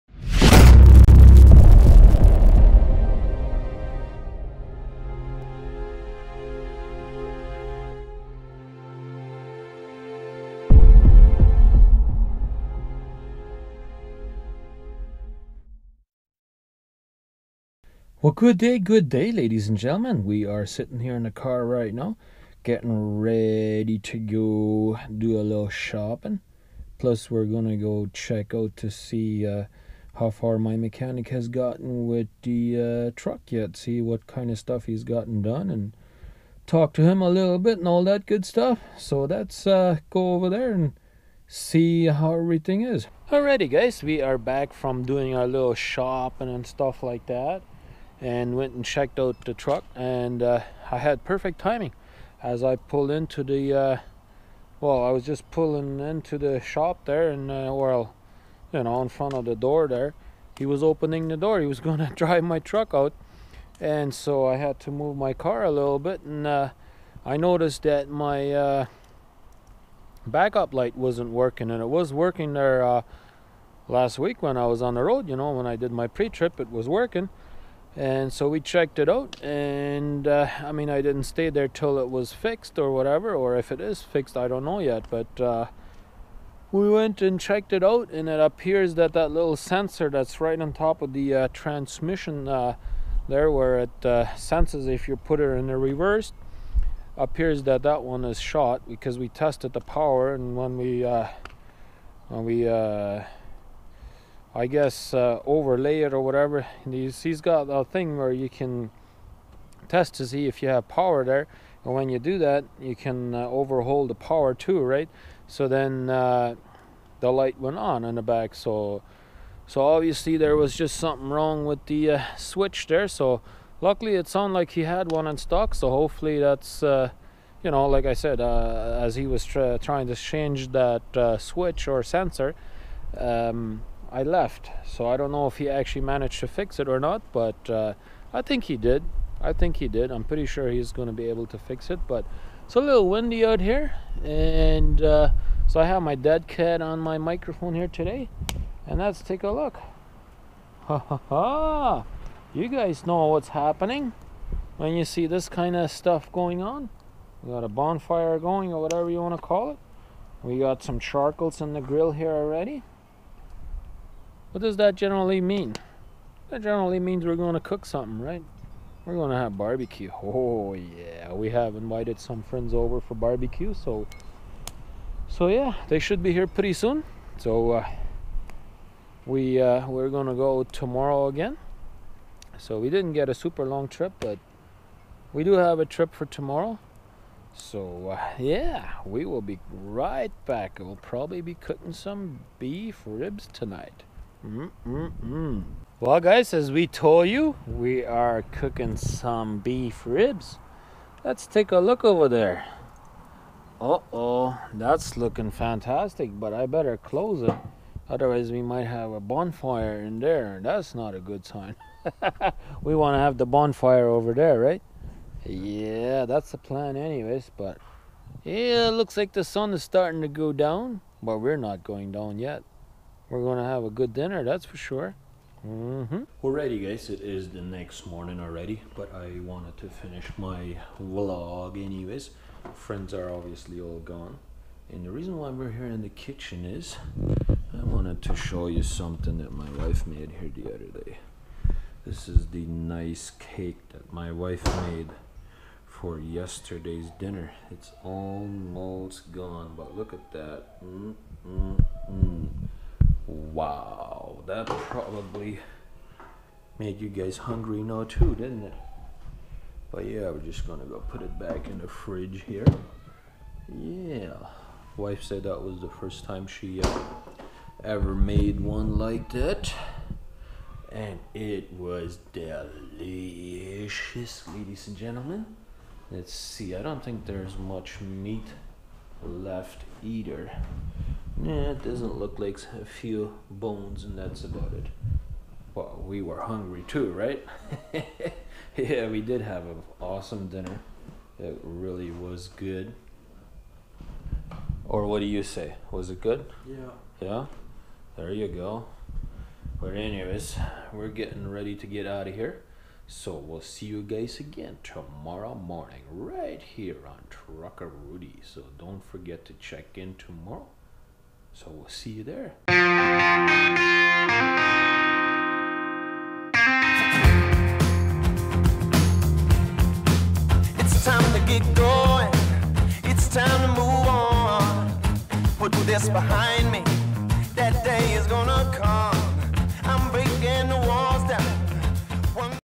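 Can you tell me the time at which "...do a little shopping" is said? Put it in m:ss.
0:25.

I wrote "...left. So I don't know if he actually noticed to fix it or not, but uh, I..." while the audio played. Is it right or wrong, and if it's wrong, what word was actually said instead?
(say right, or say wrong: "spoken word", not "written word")
wrong: "managed", not "noticed".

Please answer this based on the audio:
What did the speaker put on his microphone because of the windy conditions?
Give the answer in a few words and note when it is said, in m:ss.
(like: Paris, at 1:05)
dead cat, at 2:26.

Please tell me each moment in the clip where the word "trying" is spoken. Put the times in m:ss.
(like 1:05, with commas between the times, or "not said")
2:09.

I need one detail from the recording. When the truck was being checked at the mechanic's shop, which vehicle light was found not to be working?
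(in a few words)
backup light.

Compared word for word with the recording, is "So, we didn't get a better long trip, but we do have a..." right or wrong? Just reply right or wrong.
wrong.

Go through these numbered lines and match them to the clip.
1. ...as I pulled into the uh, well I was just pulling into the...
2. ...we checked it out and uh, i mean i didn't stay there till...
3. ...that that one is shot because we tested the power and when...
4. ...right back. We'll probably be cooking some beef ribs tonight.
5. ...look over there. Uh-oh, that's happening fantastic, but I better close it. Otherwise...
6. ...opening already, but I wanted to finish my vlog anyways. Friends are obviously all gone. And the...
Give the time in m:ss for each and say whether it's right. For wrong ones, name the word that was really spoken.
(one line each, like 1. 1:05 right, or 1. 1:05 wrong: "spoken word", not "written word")
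1. 0:52 right
2. 1:18 right
3. 1:37 right
4. 3:09 right
5. 3:21 wrong: "looking", not "happening"
6. 3:48 wrong: "morning", not "opening".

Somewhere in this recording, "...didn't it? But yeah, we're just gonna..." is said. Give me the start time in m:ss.
4:18.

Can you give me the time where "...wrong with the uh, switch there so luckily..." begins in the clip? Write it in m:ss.
2:01.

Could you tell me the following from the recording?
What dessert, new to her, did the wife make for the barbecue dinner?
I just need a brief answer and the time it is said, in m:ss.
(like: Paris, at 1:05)
cake, at 4:03.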